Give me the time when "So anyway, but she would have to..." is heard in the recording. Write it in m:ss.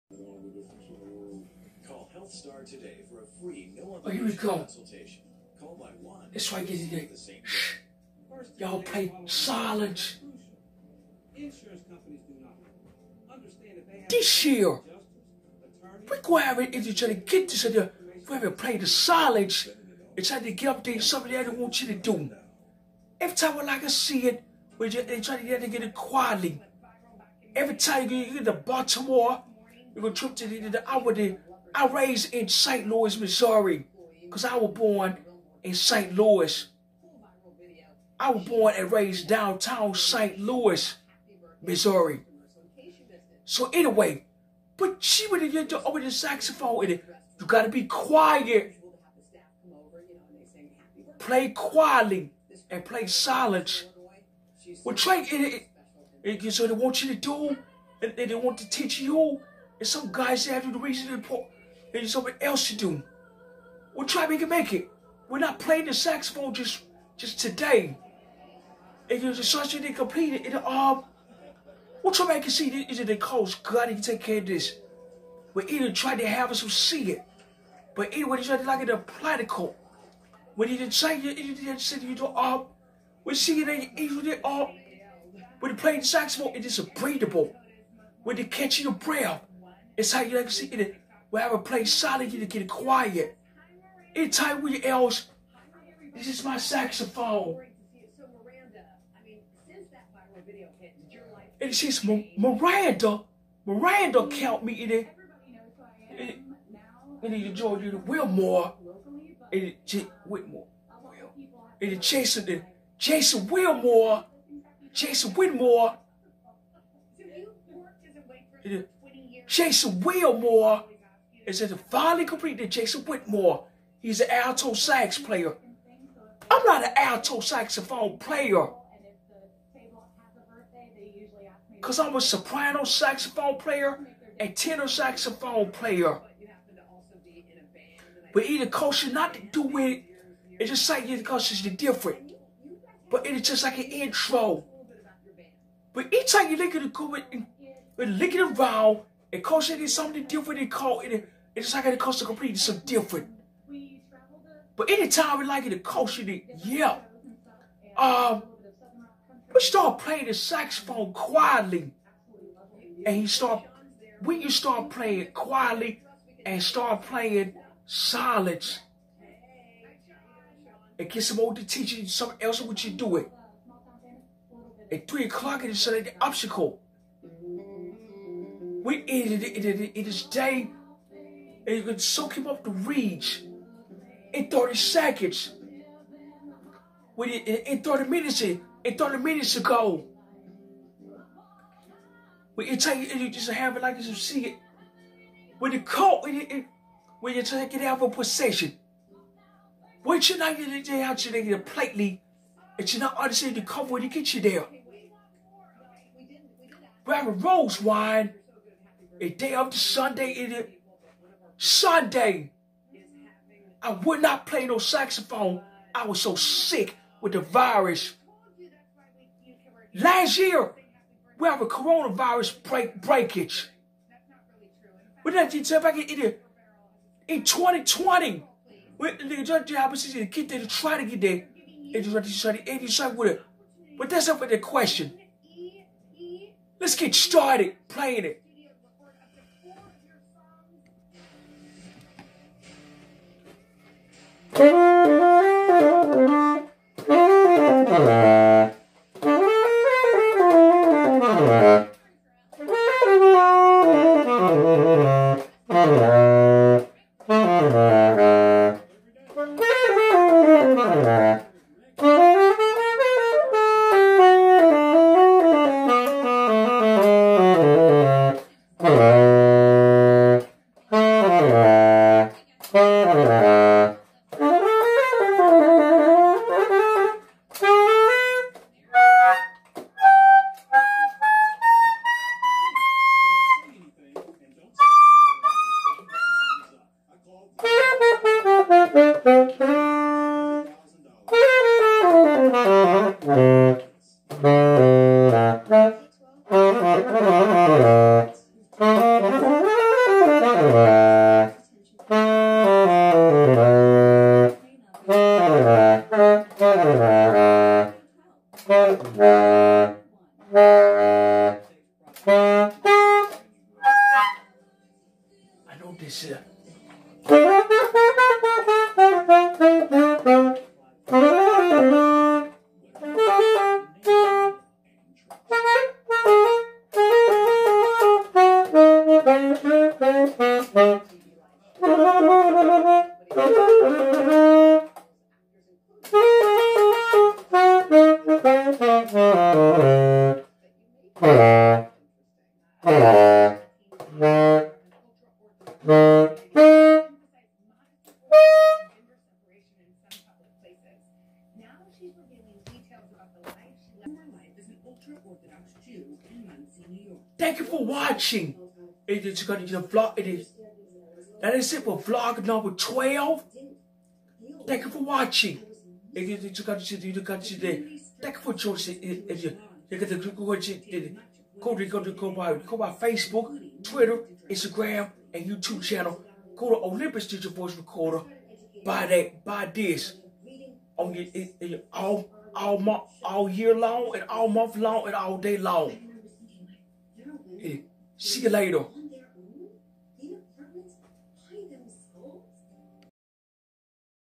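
0:43.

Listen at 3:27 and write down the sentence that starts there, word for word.
Grab a rose wine a day after Sunday, it Sunday.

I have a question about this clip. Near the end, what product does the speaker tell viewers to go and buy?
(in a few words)
Olympus Digital Voice Recorder.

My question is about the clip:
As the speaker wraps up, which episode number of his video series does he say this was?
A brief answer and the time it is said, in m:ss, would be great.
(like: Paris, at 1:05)
12, at 6:02.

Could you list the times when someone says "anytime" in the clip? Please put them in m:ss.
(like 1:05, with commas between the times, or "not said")
2:34.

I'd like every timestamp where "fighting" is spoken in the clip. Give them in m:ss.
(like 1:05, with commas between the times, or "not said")
not said.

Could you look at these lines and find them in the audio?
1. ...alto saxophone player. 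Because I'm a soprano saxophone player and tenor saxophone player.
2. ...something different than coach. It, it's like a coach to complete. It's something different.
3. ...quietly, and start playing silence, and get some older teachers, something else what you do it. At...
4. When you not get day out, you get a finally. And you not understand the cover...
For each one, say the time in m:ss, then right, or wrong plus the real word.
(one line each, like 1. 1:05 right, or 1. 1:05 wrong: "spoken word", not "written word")
1. 2:06 right
2. 2:29 right
3. 2:45 right
4. 3:20 wrong: "plately", not "finally".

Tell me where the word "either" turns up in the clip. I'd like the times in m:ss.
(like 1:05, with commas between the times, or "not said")
1:15, 2:18.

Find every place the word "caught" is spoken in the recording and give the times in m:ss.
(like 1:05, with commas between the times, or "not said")
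3:15.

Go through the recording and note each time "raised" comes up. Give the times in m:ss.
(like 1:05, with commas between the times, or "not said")
0:31, 0:38.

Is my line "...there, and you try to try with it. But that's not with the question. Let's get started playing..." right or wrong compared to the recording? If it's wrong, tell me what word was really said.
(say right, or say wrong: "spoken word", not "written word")
right.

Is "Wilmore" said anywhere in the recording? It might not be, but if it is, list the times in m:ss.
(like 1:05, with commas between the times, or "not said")
1:48, 1:53, 2:00.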